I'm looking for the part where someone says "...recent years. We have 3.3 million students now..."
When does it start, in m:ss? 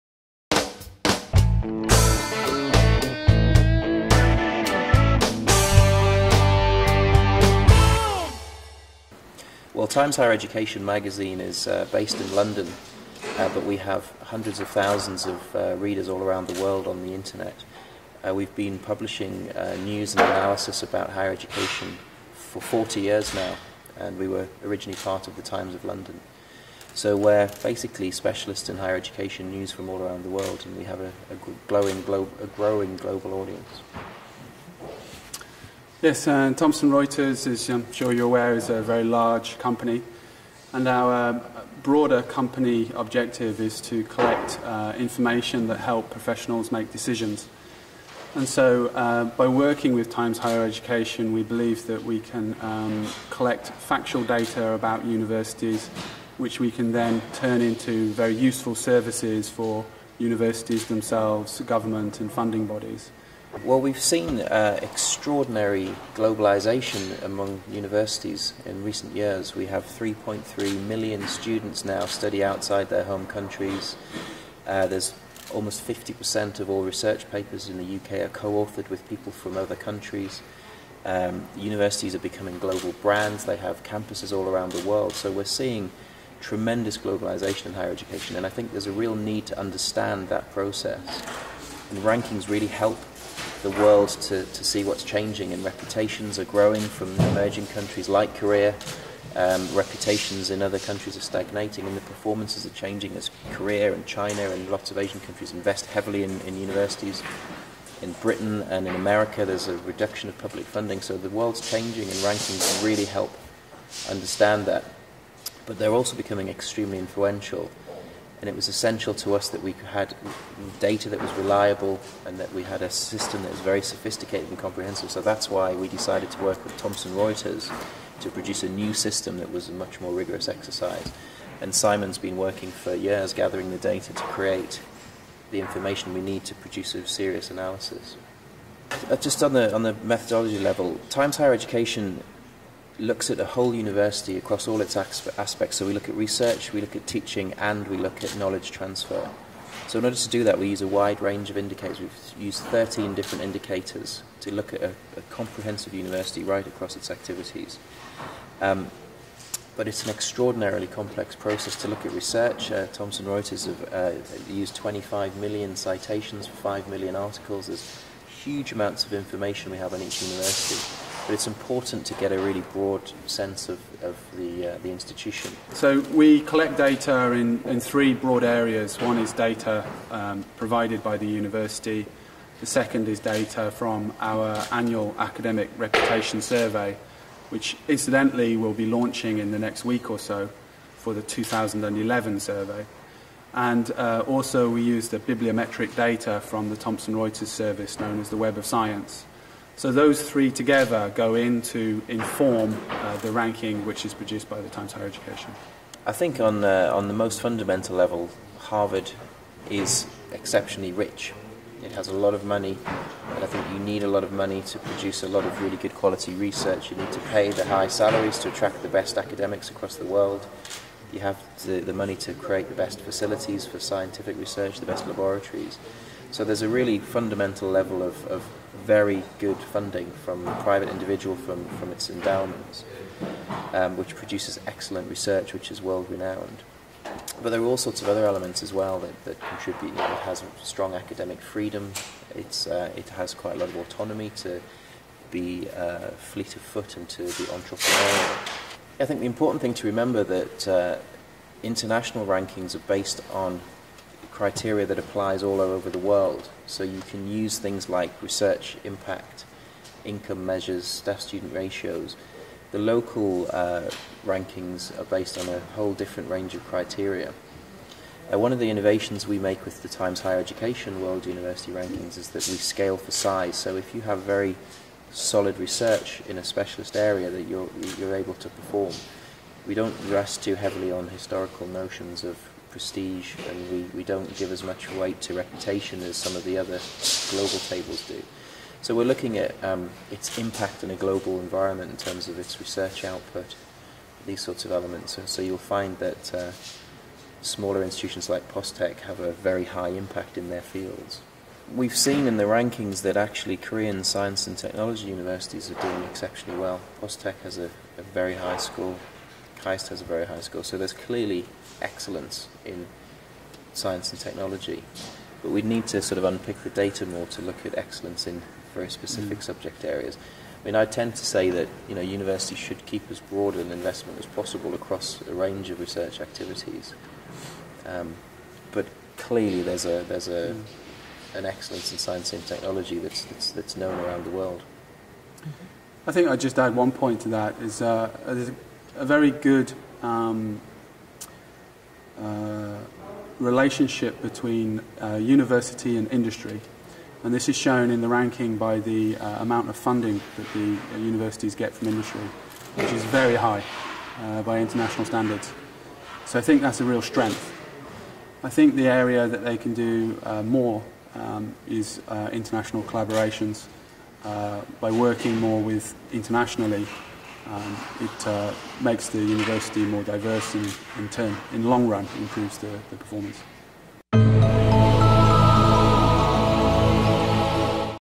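1:08.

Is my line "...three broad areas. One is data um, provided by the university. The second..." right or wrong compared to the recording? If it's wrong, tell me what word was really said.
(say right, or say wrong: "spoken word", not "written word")
right.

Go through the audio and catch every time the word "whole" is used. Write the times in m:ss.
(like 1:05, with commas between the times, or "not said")
2:23, 4:25.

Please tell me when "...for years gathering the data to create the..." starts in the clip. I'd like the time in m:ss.
2:12.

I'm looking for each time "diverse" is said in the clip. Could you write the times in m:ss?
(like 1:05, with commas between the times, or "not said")
6:10.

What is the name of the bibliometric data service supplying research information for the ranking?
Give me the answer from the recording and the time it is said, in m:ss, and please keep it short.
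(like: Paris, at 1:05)
Web of Science, at 3:18.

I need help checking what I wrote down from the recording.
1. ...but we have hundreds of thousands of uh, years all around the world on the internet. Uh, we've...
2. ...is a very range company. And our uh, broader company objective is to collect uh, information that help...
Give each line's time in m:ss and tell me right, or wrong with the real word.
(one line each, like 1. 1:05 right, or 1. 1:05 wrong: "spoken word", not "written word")
1. 0:13 wrong: "readers", not "years"
2. 0:38 wrong: "large", not "range".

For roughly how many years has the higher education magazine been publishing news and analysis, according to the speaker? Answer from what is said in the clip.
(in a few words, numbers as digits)
40 years.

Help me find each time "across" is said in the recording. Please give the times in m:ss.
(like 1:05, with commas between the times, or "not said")
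2:24, 2:36, 3:39, 5:24.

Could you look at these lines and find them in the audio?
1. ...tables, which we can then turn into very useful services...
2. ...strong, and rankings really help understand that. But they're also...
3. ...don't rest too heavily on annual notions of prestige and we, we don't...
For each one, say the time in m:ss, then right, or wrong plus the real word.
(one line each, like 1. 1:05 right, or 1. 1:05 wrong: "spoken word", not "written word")
1. 0:55 wrong: "universities", not "tables"
2. 1:51 wrong: "changing", not "strong"
3. 4:39 wrong: "historical", not "annual".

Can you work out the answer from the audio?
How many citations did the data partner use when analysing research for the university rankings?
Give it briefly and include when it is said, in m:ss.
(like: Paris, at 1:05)
25 million, at 2:44.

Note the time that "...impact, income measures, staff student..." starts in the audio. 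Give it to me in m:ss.
4:18.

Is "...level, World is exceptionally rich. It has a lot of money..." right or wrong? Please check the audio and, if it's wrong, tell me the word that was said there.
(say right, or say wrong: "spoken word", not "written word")
wrong: "Harvard", not "World".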